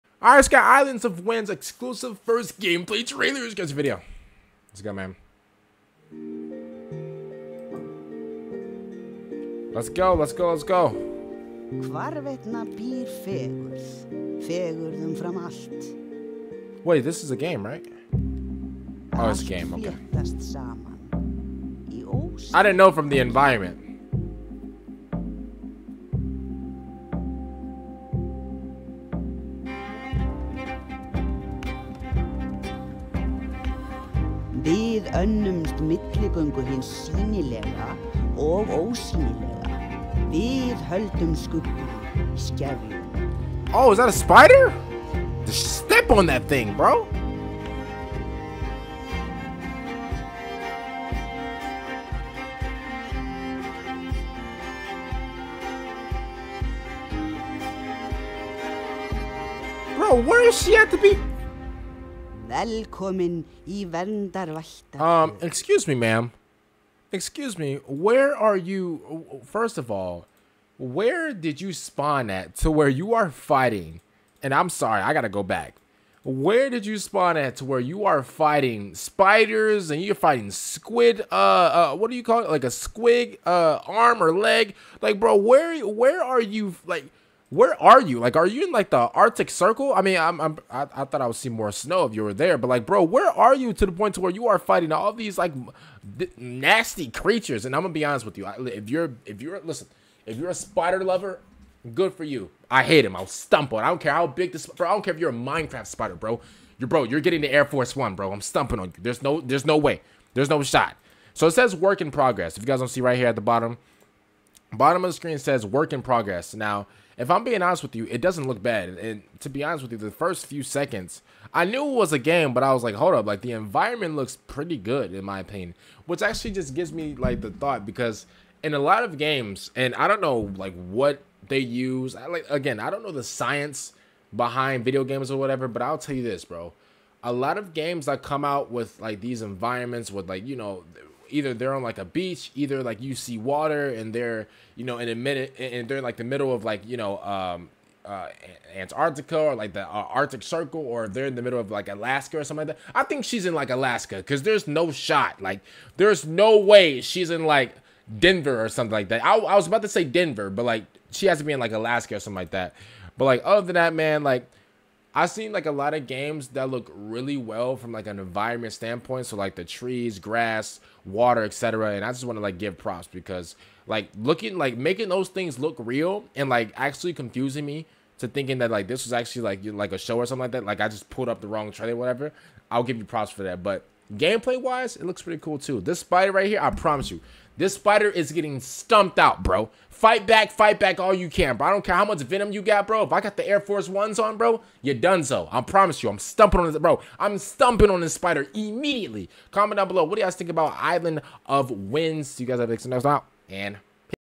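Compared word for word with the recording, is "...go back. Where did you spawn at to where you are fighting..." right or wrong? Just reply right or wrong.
right.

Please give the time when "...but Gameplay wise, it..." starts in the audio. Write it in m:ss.
3:03.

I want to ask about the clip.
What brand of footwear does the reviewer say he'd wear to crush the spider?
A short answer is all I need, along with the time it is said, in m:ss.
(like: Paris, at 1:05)
Air Force Ones, at 3:13.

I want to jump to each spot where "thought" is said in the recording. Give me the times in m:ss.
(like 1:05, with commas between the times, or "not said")
1:31, 2:07.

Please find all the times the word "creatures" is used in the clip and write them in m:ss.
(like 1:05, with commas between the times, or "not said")
1:37.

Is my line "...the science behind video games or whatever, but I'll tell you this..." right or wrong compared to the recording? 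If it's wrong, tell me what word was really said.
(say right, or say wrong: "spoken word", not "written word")
right.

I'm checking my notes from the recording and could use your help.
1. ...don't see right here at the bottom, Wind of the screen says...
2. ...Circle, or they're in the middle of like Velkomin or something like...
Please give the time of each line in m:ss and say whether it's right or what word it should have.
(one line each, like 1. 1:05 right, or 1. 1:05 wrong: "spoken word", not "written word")
1. 1:52 wrong: "Bottom", not "Wind"
2. 2:30 wrong: "Alaska", not "Velkomin".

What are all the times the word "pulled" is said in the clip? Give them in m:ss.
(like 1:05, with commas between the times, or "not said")
3:01.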